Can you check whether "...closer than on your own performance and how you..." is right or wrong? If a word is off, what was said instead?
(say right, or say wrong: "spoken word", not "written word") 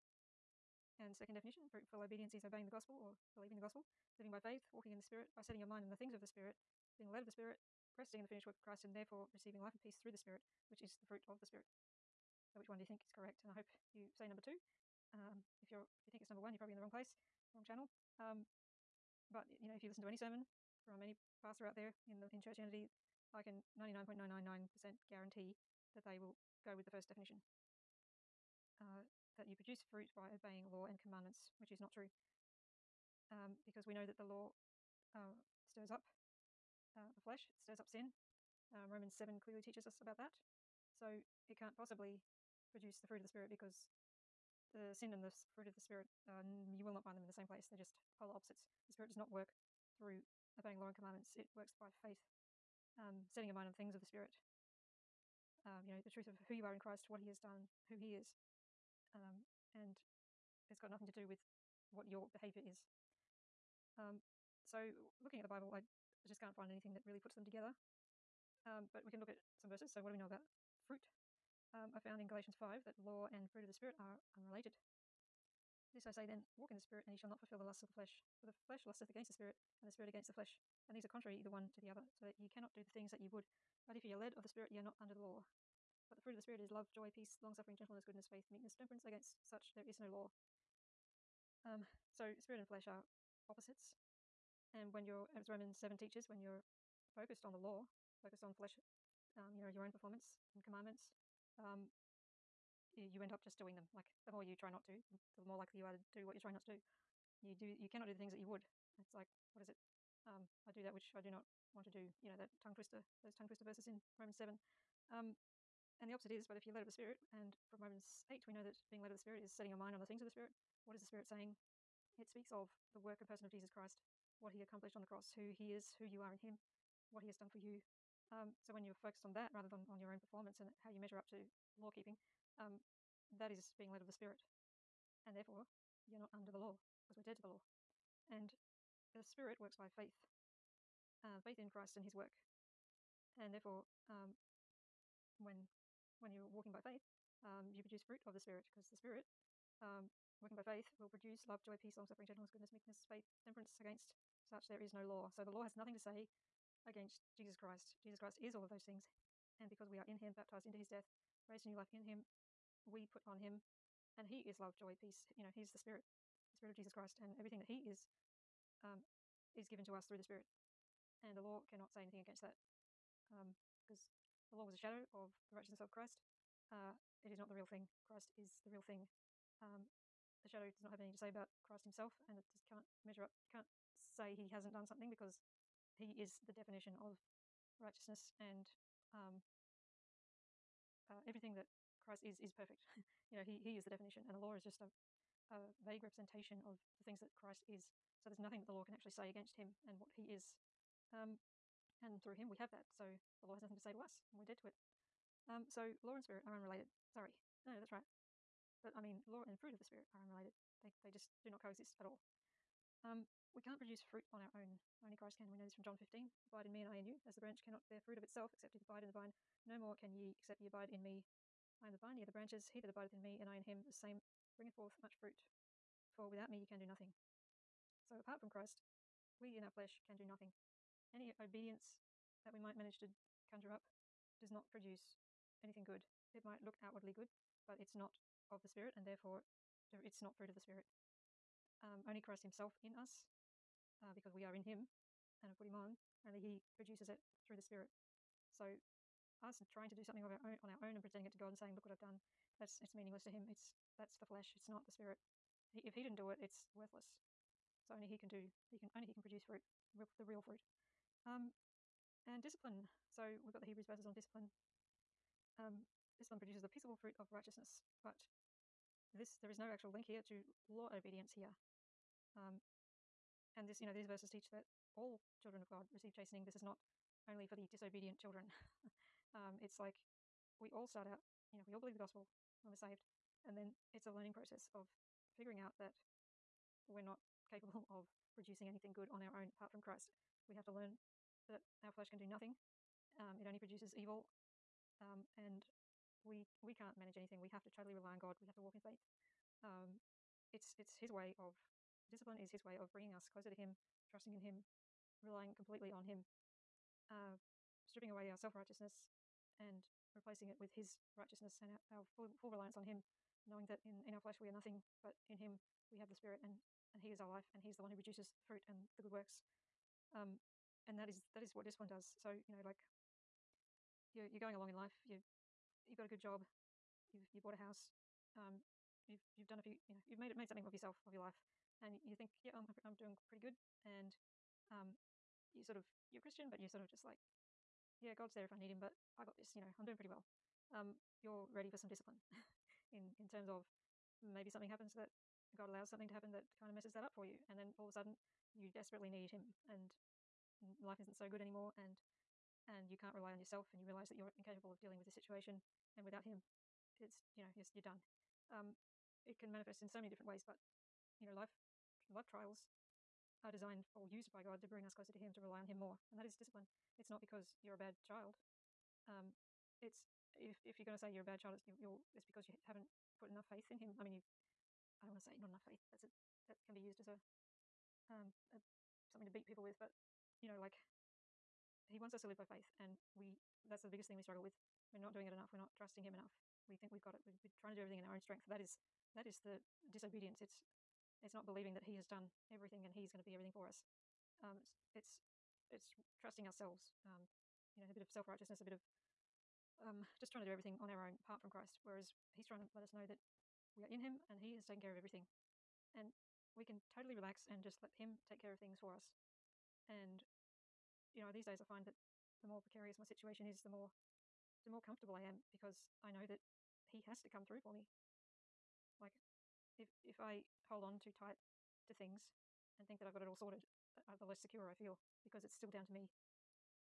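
wrong: "rather", not "closer".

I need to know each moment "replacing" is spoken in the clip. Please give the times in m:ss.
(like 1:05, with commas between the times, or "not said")
5:10.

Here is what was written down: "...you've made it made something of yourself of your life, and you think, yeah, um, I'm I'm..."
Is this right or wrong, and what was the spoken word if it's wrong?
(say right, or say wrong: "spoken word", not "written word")
right.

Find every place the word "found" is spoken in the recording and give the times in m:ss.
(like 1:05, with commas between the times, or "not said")
1:11.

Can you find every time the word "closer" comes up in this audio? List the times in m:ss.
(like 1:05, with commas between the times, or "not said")
5:03, 6:04.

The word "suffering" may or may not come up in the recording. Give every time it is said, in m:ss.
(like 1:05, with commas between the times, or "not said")
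1:27, 2:32.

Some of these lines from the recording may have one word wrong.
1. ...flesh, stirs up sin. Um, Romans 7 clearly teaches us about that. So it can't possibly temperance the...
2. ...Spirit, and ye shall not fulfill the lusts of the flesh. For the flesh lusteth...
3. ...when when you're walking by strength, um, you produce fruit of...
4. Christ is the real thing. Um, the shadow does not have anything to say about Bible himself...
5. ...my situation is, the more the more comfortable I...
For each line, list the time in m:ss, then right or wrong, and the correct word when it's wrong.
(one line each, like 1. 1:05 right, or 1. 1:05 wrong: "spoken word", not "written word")
1. 0:37 wrong: "produce", not "temperance"
2. 1:16 right
3. 2:25 wrong: "faith", not "strength"
4. 2:58 wrong: "Christ", not "Bible"
5. 6:52 right.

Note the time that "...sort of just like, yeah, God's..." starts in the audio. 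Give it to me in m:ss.
5:36.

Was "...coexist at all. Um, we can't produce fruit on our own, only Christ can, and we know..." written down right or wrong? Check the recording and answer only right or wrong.
right.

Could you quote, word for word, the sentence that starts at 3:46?
For without me you can do nothing.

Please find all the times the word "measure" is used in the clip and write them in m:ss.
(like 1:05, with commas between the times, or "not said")
2:10, 3:03.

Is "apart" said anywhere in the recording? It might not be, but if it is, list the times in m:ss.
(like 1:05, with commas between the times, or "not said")
3:48, 4:49, 6:41.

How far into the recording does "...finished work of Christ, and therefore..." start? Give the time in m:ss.
0:08.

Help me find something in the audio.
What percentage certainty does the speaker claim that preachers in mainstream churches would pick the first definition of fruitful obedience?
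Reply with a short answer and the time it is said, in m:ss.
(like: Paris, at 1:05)
99.999%, at 0:23.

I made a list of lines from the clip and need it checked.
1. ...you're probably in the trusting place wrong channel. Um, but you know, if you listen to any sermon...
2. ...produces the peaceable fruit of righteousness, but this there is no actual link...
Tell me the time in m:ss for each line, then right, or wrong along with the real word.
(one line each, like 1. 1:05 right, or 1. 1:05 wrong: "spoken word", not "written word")
1. 0:16 wrong: "wrong", not "trusting"
2. 4:26 right.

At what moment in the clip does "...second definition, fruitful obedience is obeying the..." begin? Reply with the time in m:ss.
0:01.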